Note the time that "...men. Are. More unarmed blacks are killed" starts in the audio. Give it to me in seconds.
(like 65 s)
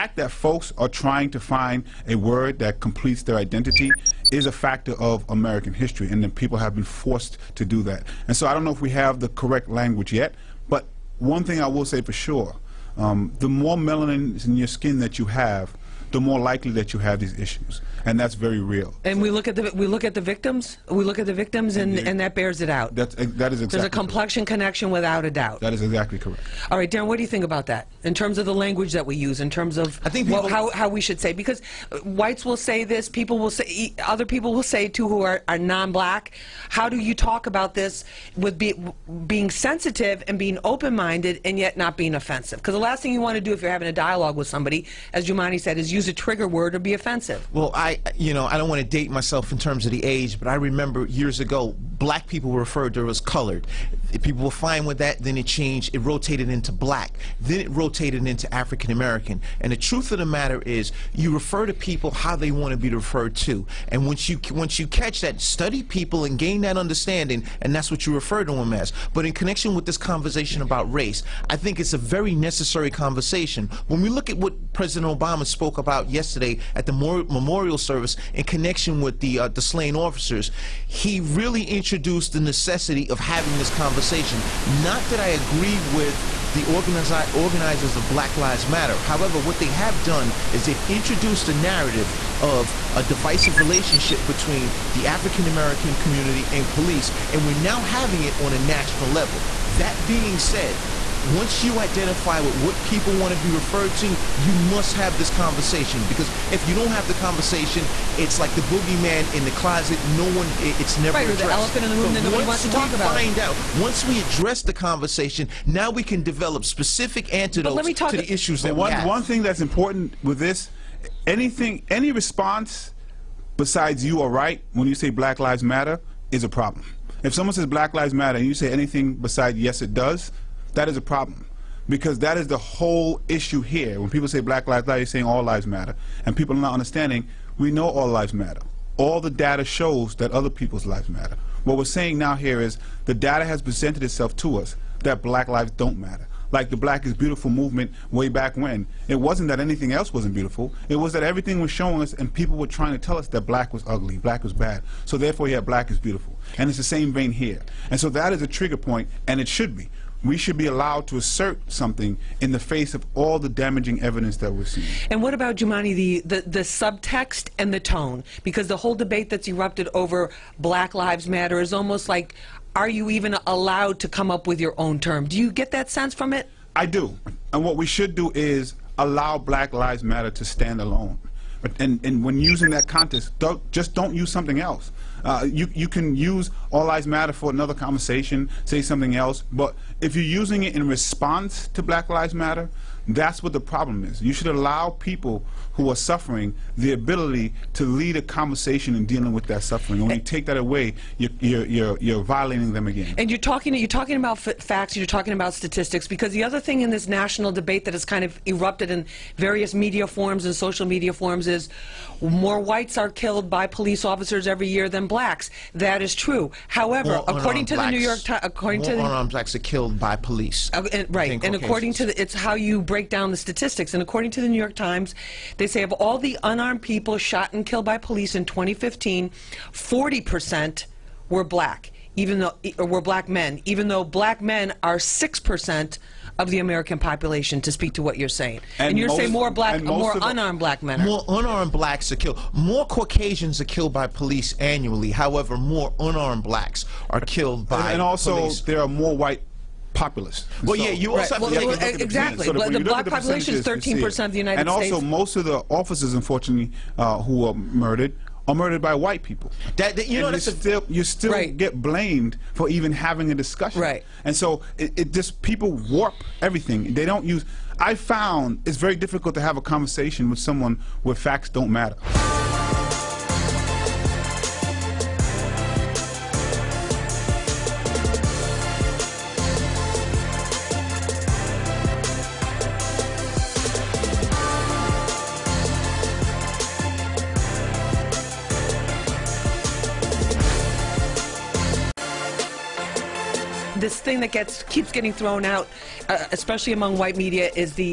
240 s.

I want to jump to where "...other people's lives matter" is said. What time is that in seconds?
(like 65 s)
140 s.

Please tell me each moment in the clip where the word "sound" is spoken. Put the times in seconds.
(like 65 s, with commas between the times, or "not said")
not said.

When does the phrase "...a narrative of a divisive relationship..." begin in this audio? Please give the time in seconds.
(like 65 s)
91 s.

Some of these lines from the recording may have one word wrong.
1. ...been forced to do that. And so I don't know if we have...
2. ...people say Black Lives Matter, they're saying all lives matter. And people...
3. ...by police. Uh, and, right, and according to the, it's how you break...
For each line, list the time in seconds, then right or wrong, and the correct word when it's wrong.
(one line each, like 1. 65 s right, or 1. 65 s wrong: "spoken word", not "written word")
1. 6 s right
2. 134 s right
3. 219 s right.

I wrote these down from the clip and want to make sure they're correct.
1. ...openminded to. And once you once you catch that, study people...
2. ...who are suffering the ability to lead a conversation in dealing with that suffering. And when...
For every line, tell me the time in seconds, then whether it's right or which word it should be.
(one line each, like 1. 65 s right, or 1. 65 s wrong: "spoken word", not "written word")
1. 62 s wrong: "referred", not "openminded"
2. 195 s right.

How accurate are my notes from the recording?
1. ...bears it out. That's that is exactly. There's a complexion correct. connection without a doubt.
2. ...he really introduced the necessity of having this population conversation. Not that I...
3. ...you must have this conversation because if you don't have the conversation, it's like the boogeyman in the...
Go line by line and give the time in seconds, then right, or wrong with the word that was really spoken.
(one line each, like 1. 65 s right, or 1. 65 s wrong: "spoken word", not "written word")
1. 22 s right
2. 80 s wrong: "conversation", not "population"
3. 104 s right.